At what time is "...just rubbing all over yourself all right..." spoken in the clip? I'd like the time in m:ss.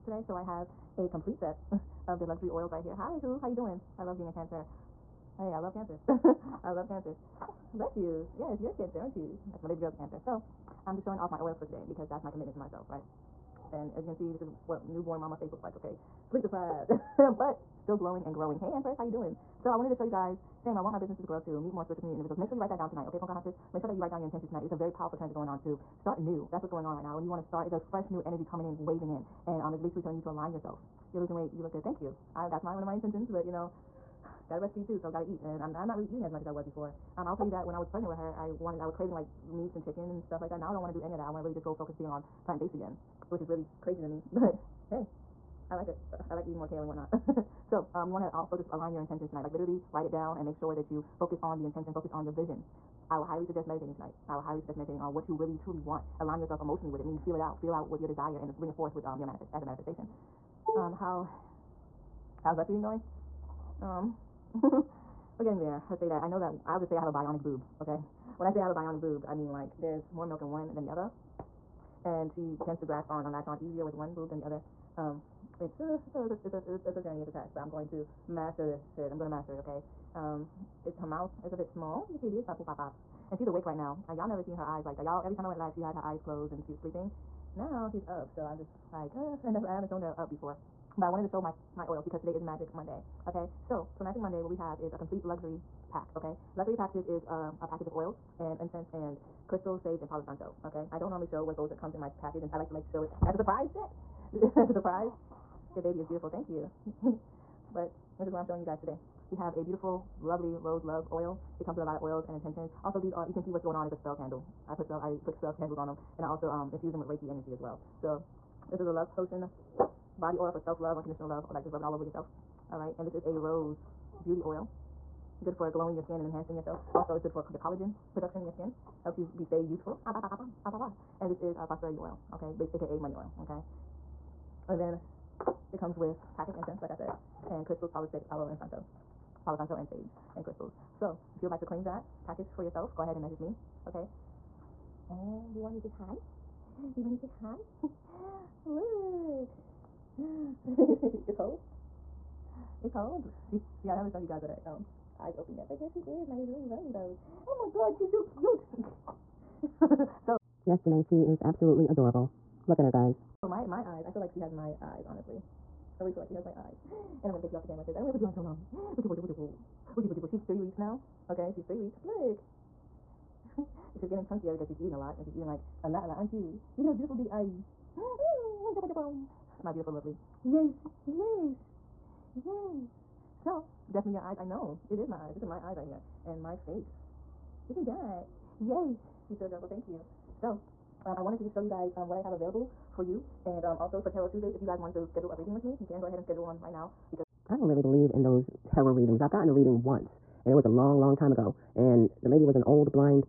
2:01.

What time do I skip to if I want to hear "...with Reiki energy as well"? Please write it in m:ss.
1:57.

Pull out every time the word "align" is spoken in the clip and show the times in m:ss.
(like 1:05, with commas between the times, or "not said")
0:30, 0:48, 0:56.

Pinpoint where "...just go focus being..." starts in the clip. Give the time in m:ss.
0:41.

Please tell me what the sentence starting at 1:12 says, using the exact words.
And she tends to grasp on and latch on easier with one boob than the other.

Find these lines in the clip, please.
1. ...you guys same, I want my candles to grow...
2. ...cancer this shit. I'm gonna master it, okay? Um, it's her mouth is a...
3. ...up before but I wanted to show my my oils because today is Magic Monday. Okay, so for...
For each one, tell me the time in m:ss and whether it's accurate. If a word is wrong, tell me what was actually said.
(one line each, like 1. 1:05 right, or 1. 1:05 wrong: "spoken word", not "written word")
1. 0:20 wrong: "businesses", not "candles"
2. 1:18 wrong: "master", not "cancer"
3. 1:30 right.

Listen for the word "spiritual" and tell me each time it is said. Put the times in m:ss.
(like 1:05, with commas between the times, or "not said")
0:21.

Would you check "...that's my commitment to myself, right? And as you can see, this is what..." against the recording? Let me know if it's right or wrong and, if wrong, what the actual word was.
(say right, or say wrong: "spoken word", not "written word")
right.